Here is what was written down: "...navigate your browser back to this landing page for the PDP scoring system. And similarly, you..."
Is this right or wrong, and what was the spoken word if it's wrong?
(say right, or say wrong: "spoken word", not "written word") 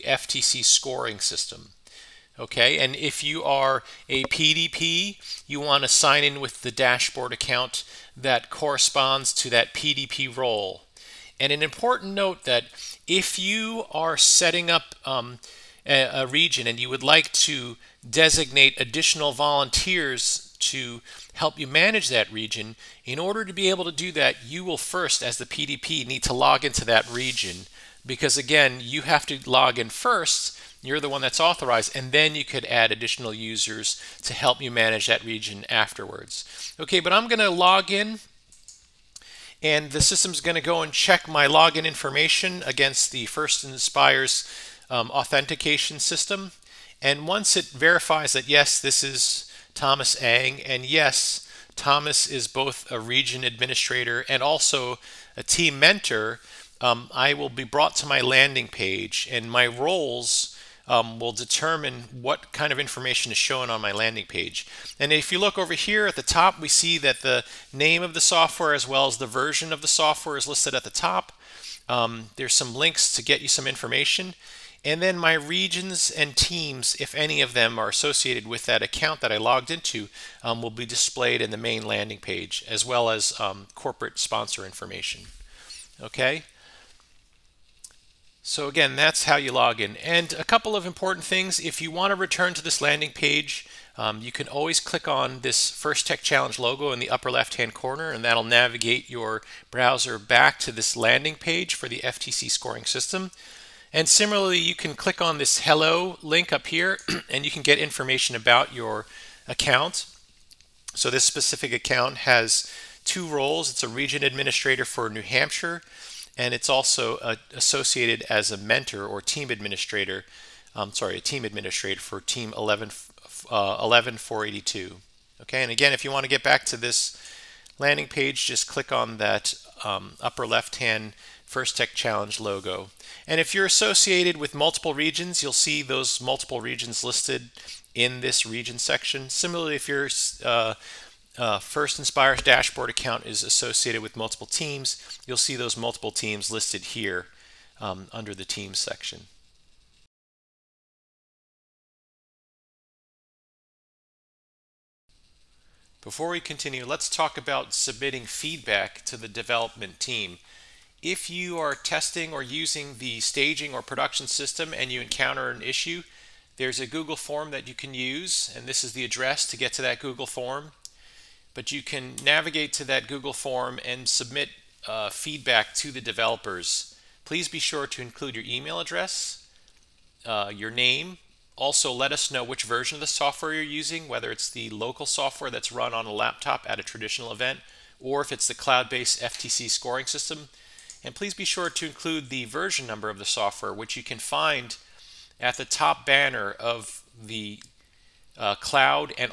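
wrong: "FTC", not "PDP".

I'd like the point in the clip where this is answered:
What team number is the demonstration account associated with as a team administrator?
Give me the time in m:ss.
2:03.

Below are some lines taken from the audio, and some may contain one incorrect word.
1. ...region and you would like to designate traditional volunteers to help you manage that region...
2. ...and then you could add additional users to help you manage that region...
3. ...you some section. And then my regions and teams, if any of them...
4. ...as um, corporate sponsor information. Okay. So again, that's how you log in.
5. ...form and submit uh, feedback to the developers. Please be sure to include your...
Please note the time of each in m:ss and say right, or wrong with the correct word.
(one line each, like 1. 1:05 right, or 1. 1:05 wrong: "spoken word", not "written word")
1. 0:16 wrong: "additional", not "traditional"
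2. 0:31 right
3. 1:13 wrong: "information", not "section"
4. 1:23 right
5. 2:53 right.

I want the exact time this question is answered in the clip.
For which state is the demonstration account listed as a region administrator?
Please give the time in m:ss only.
1:55.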